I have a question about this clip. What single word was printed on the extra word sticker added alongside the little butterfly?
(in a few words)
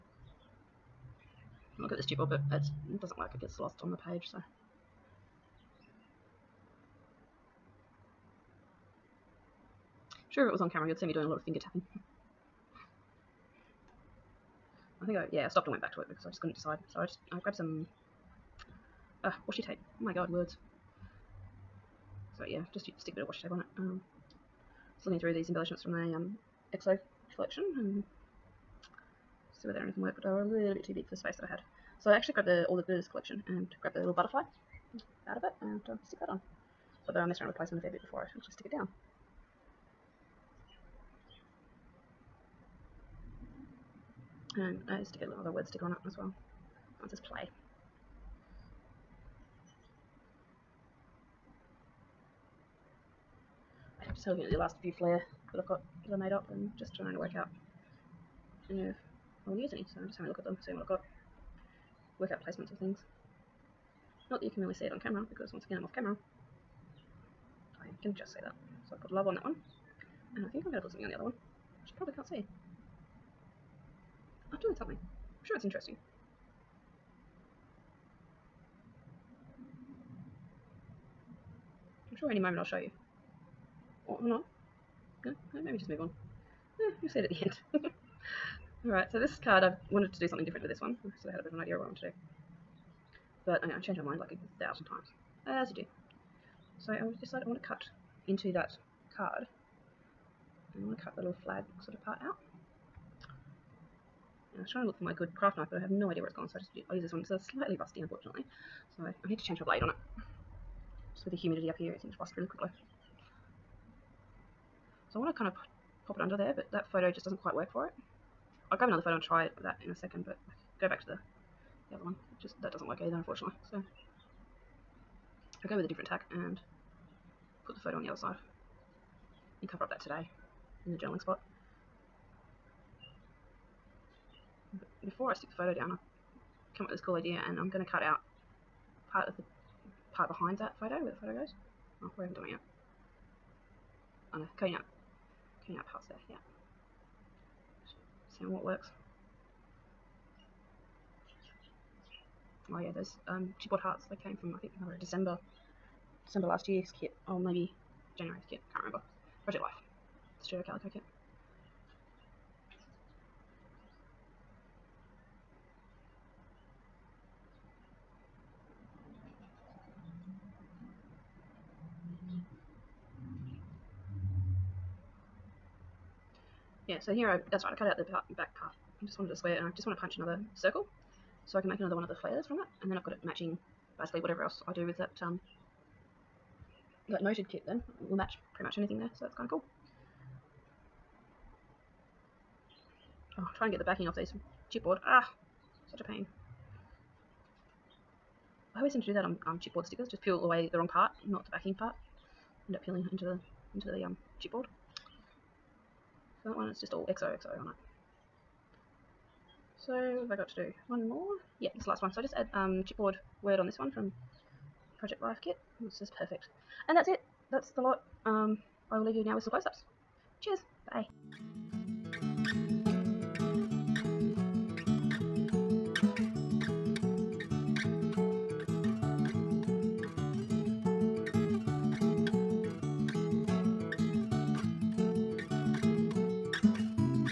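play.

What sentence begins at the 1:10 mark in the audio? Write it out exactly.
And I think I'm going to put something on the other one, which you probably can't see.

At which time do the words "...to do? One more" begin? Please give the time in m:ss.
3:30.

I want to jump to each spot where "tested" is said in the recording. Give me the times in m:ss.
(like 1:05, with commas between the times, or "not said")
not said.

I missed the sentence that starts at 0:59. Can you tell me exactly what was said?
So I'm just having a look at them, seeing what I've got, work out placements of things.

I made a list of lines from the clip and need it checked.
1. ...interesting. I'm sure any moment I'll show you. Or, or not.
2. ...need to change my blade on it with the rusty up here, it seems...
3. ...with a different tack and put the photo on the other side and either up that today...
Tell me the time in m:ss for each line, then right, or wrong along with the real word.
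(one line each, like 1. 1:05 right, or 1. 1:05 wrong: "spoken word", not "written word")
1. 1:15 right
2. 1:49 wrong: "humidity", not "rusty"
3. 2:05 wrong: "cover", not "either".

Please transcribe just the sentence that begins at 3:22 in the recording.
End up peeling into the into the um, chipboard.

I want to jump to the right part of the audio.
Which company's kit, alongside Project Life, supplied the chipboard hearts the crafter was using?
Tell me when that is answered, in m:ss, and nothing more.
2:40.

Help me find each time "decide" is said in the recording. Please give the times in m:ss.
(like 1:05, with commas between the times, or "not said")
0:16, 1:37.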